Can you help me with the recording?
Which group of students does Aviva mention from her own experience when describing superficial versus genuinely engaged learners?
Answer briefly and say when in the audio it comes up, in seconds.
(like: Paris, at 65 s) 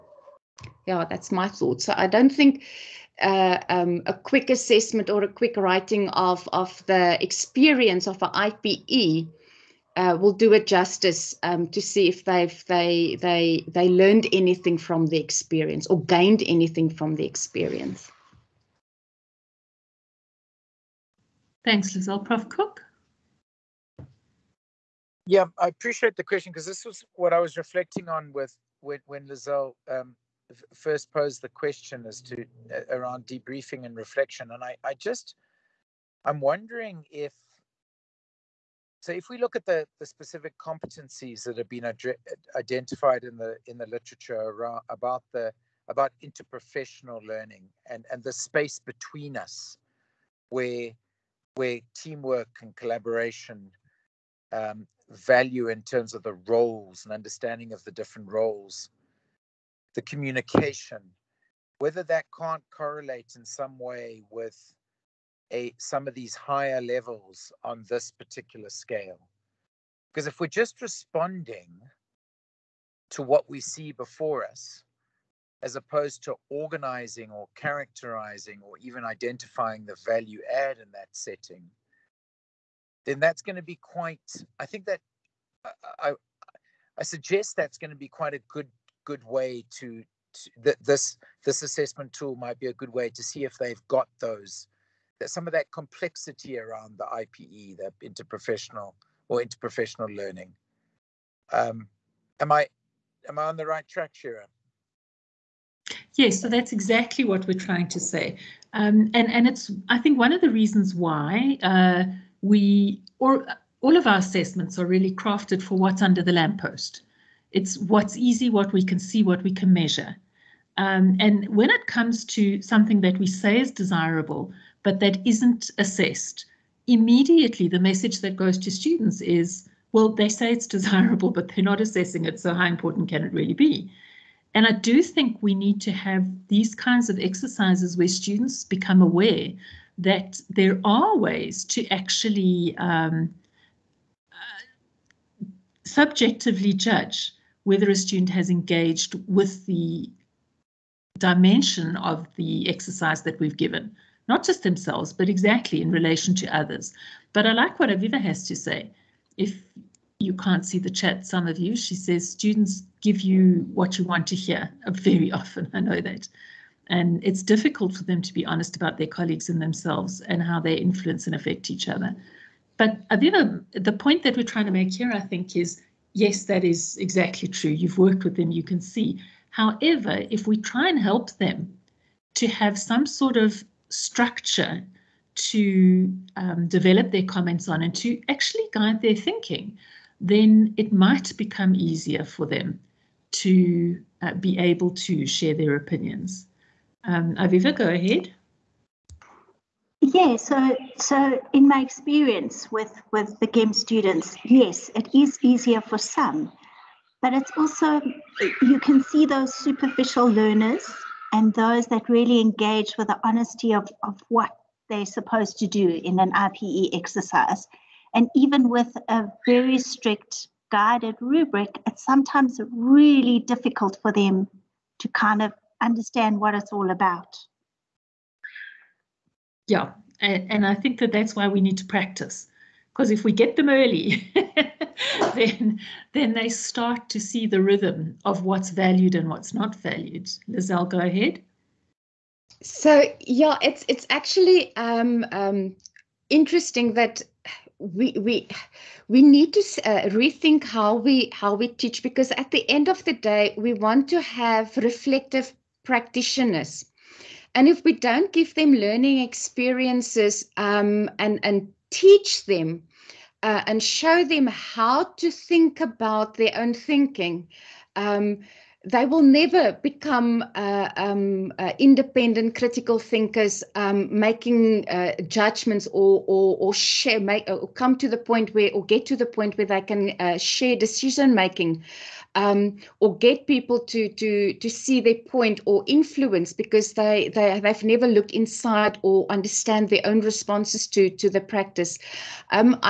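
GEM students, at 203 s.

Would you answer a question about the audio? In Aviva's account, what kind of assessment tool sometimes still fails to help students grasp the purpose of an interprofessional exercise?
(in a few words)
strict guided rubric.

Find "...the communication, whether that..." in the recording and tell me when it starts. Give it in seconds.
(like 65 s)
59 s.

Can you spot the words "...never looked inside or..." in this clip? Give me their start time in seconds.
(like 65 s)
287 s.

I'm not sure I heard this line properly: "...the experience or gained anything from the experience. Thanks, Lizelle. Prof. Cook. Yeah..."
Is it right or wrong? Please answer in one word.
right.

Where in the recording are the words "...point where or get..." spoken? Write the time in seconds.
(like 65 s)
278 s.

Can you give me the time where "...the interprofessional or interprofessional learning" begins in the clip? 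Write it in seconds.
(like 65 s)
97 s.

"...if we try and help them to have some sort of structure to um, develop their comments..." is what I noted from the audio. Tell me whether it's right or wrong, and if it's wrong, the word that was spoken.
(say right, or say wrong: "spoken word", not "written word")
right.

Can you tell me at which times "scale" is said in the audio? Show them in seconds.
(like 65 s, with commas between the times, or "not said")
68 s.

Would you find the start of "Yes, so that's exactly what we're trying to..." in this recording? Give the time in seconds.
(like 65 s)
106 s.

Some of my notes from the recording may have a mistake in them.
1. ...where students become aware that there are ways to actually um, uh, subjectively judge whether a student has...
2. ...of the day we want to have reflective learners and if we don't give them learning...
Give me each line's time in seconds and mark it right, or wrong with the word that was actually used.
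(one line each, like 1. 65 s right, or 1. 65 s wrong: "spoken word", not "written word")
1. 137 s right
2. 252 s wrong: "practitioners", not "learners".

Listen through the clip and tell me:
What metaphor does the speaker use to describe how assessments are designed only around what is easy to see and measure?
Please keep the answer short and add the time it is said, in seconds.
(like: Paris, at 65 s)
under the lamppost, at 116 s.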